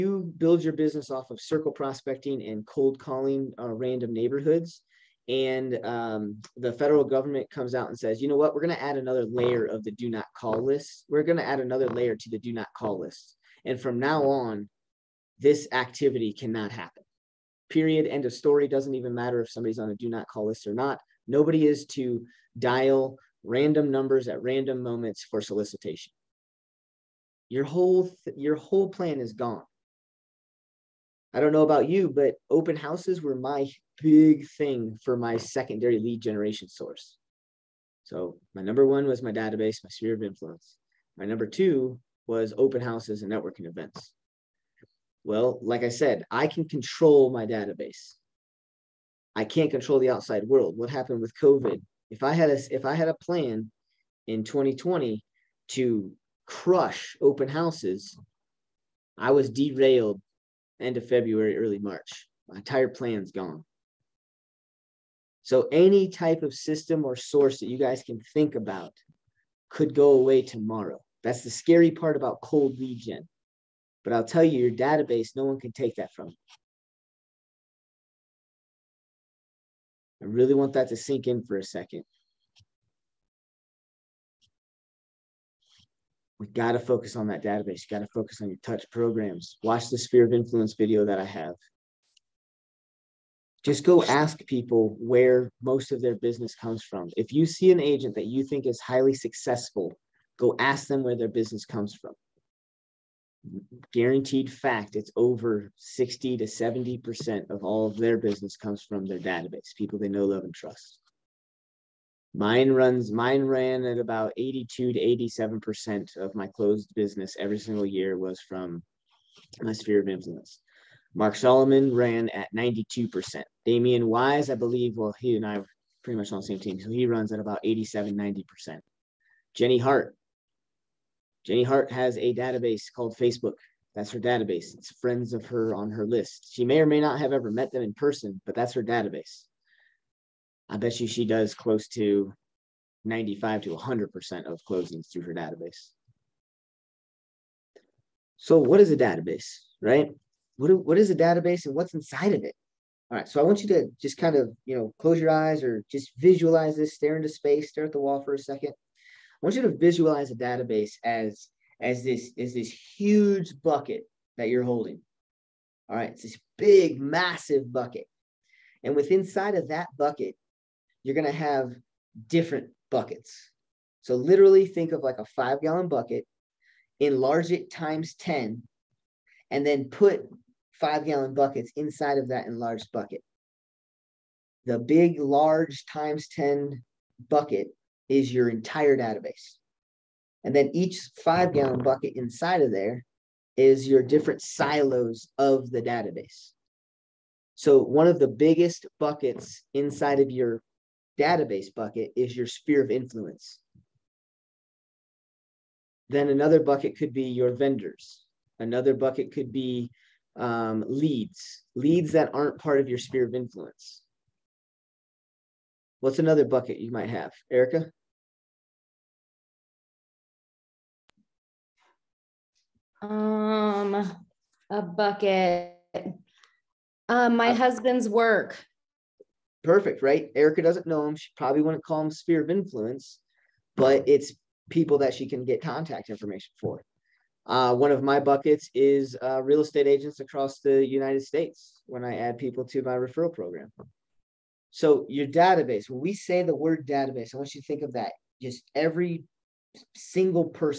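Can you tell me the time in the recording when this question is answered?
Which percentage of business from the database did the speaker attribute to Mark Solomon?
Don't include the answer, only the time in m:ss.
2:02.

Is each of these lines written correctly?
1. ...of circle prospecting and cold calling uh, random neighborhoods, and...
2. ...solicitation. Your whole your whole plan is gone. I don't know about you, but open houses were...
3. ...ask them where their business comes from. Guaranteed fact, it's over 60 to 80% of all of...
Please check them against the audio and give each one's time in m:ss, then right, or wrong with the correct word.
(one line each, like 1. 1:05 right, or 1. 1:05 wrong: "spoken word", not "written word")
1. 0:01 right
2. 0:25 right
3. 1:40 wrong: "70", not "80".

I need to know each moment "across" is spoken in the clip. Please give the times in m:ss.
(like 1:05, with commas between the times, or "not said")
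4:00.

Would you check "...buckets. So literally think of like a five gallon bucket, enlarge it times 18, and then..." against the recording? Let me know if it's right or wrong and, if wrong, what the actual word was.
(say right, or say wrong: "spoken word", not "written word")
wrong: "10", not "18".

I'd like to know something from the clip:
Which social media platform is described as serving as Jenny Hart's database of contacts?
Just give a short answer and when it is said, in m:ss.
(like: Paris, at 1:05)
Facebook, at 2:13.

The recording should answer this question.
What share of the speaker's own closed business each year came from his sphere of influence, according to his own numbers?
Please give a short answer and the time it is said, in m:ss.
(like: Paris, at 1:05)
82 to 87%, at 1:54.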